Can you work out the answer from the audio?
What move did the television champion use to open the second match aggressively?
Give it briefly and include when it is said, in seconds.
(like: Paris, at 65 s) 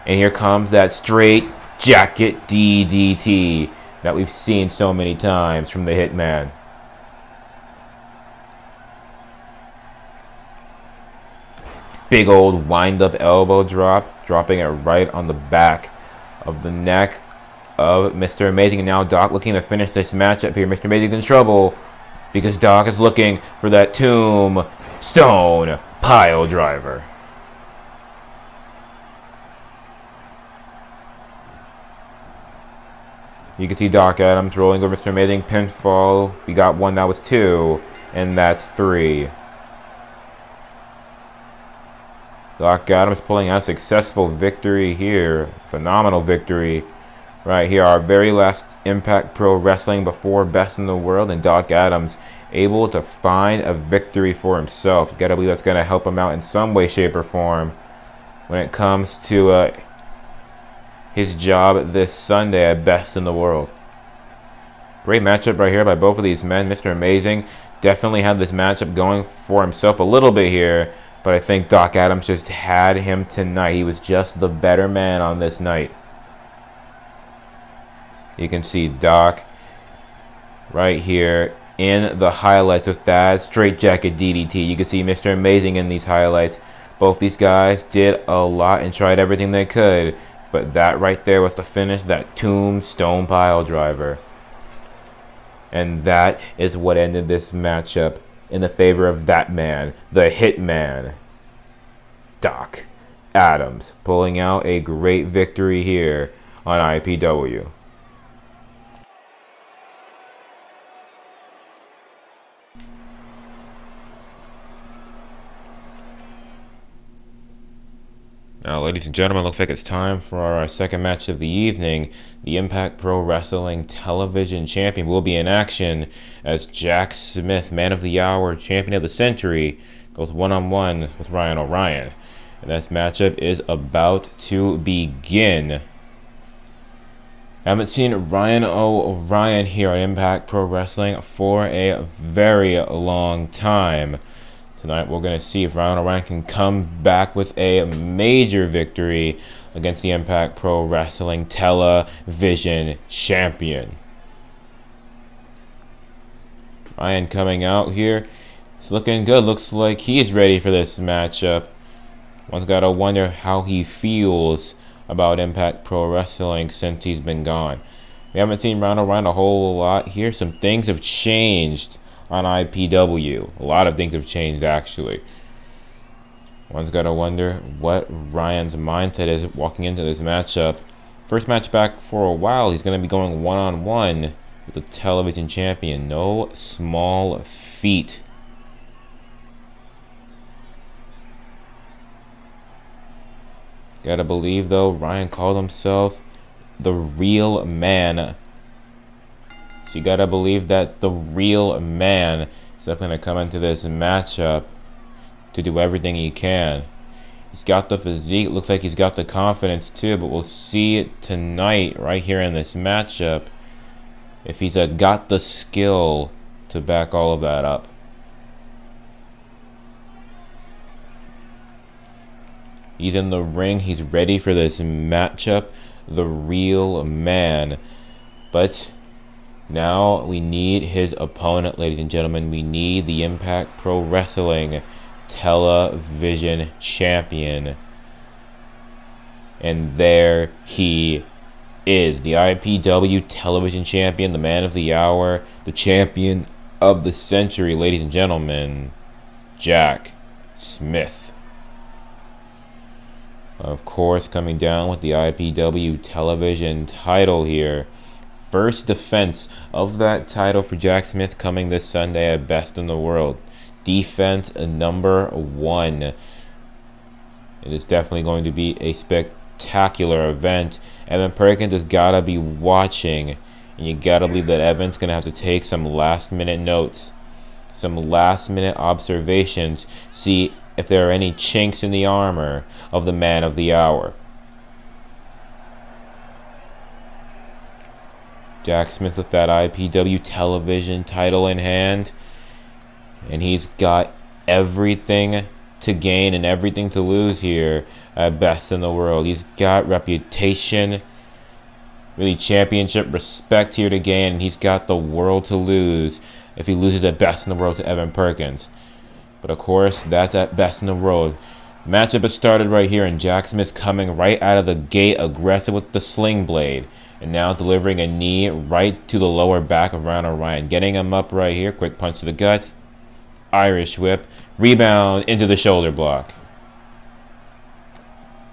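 Sling blade, at 316 s.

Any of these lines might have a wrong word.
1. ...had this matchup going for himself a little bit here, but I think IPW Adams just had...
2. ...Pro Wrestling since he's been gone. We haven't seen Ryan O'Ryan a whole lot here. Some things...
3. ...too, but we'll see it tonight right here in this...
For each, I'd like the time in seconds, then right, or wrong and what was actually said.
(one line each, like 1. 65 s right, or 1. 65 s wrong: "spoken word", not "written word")
1. 68 s wrong: "Doc", not "IPW"
2. 165 s right
3. 209 s right.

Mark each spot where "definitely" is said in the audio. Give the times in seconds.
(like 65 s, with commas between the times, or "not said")
67 s, 202 s, 267 s.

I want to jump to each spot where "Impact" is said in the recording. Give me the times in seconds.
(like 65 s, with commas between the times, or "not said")
48 s, 122 s, 139 s, 150 s, 165 s, 233 s.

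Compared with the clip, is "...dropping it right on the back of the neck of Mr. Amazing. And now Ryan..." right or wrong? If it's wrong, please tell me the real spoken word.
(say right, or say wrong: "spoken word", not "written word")
wrong: "Doc", not "Ryan".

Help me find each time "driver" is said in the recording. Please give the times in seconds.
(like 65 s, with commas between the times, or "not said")
26 s, 93 s.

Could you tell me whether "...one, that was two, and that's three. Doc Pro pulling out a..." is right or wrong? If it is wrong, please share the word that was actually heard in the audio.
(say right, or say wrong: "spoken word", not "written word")
wrong: "Adams", not "Pro".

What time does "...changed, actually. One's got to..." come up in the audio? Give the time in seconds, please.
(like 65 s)
174 s.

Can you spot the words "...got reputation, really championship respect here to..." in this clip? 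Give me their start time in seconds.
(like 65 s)
299 s.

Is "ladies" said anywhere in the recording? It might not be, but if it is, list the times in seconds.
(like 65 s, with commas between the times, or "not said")
118 s, 231 s, 247 s.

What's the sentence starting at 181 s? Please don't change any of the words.
First match back for a while, he's going to be going one on one with the television champion.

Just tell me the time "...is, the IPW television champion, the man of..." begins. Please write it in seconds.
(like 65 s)
241 s.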